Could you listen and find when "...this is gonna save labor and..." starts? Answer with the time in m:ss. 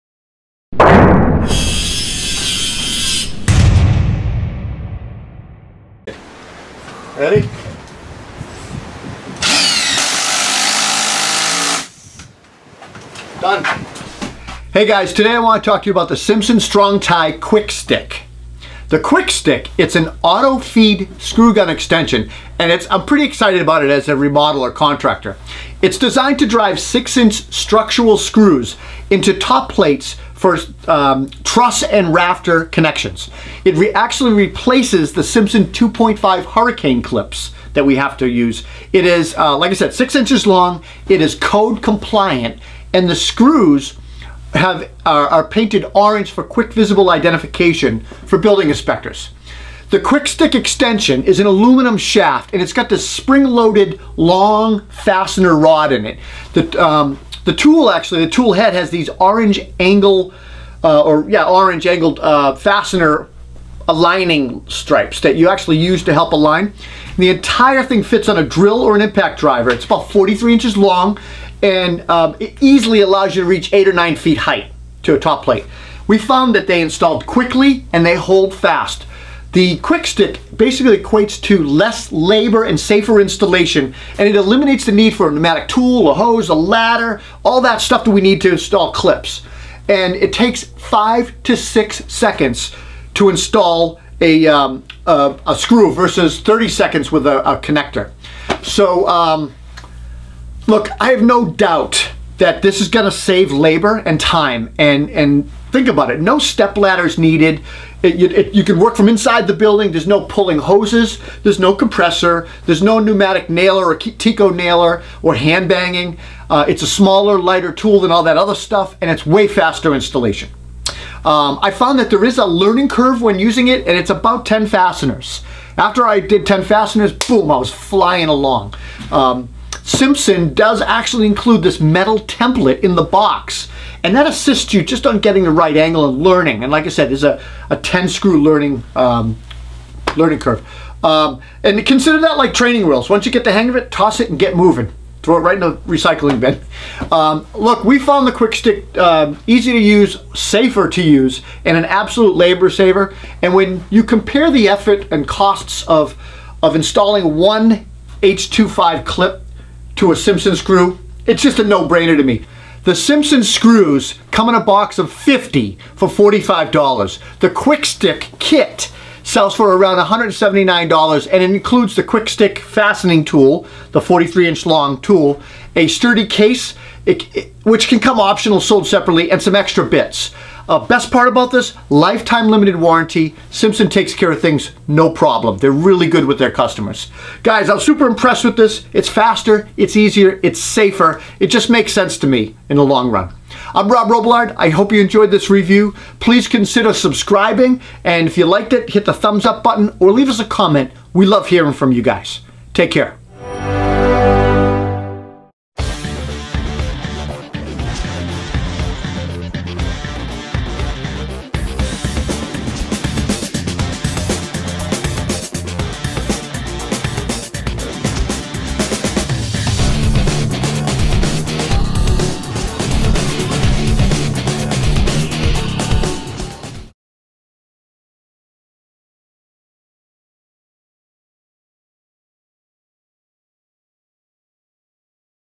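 1:42.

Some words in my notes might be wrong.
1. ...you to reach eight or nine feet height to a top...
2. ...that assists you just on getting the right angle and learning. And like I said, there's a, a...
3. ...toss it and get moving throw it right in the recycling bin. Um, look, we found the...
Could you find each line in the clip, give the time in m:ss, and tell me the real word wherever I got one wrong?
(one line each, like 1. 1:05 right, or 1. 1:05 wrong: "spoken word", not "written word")
1. 1:13 right
2. 2:14 right
3. 2:23 right.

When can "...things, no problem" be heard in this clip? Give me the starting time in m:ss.
3:04.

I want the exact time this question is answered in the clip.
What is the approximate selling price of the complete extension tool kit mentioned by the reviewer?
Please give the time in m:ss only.
2:49.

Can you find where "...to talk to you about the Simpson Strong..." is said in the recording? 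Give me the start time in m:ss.
0:15.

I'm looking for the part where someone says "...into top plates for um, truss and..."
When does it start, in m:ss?
0:29.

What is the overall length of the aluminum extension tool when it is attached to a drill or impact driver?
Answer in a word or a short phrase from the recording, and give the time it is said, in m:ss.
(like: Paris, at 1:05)
43 inches, at 1:10.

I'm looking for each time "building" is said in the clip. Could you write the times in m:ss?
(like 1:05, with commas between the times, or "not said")
0:48, 1:49.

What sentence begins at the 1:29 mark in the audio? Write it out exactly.
And it takes five to six seconds to install a, um, a, a, screw versus 30 seconds with a, a connector.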